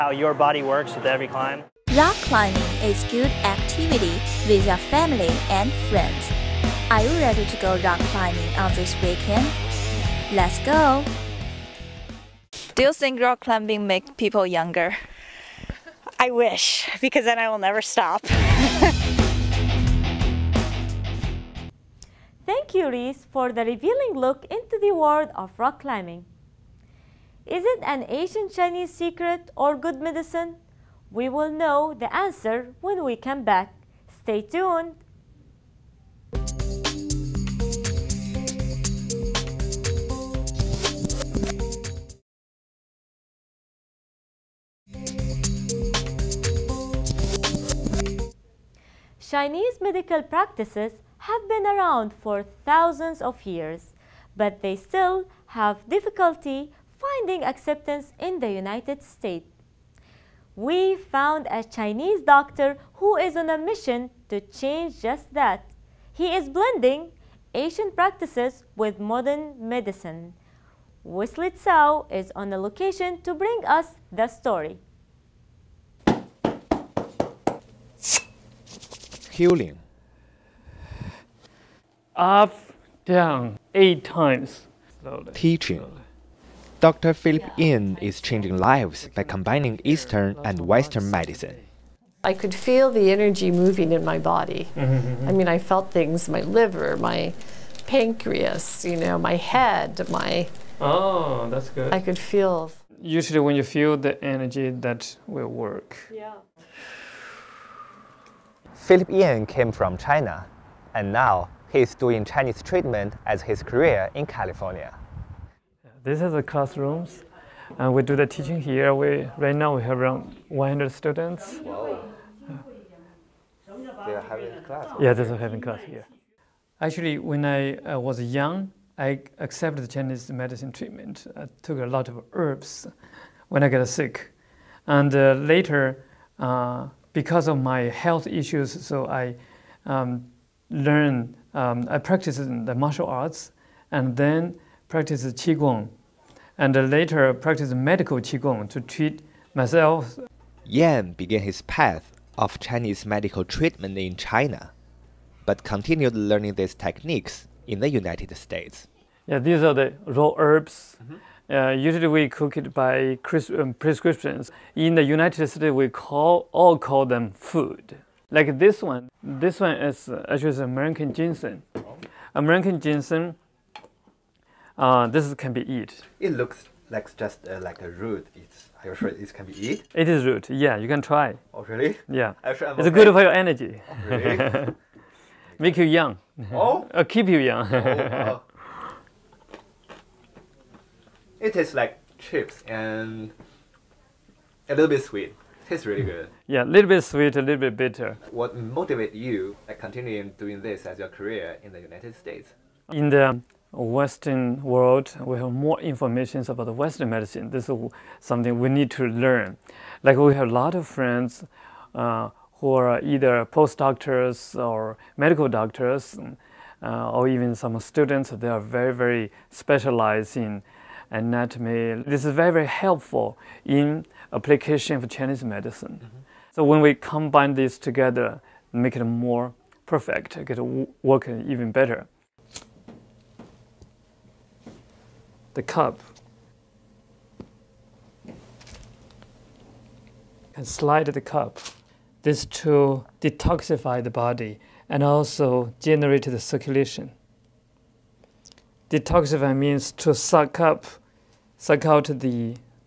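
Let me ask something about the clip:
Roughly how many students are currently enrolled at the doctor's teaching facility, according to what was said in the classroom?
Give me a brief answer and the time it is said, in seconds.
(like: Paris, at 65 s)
100, at 120 s.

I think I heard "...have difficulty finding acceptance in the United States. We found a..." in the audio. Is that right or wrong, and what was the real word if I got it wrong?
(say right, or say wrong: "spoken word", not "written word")
right.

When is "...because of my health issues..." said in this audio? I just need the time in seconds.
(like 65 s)
137 s.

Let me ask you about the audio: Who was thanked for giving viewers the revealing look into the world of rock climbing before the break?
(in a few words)
Reese.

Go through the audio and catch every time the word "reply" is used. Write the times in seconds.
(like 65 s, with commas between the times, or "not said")
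not said.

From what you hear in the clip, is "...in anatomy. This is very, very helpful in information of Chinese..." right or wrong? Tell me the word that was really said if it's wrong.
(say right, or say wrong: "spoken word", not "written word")
wrong: "application", not "information".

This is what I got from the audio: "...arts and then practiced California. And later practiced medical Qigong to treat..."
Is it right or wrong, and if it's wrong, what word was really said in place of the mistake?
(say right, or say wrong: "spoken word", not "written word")
wrong: "Qigong", not "California".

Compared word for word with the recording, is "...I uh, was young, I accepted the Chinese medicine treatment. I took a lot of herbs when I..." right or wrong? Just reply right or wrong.
right.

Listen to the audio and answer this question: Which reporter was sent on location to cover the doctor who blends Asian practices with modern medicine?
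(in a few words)
Wesley Tsao.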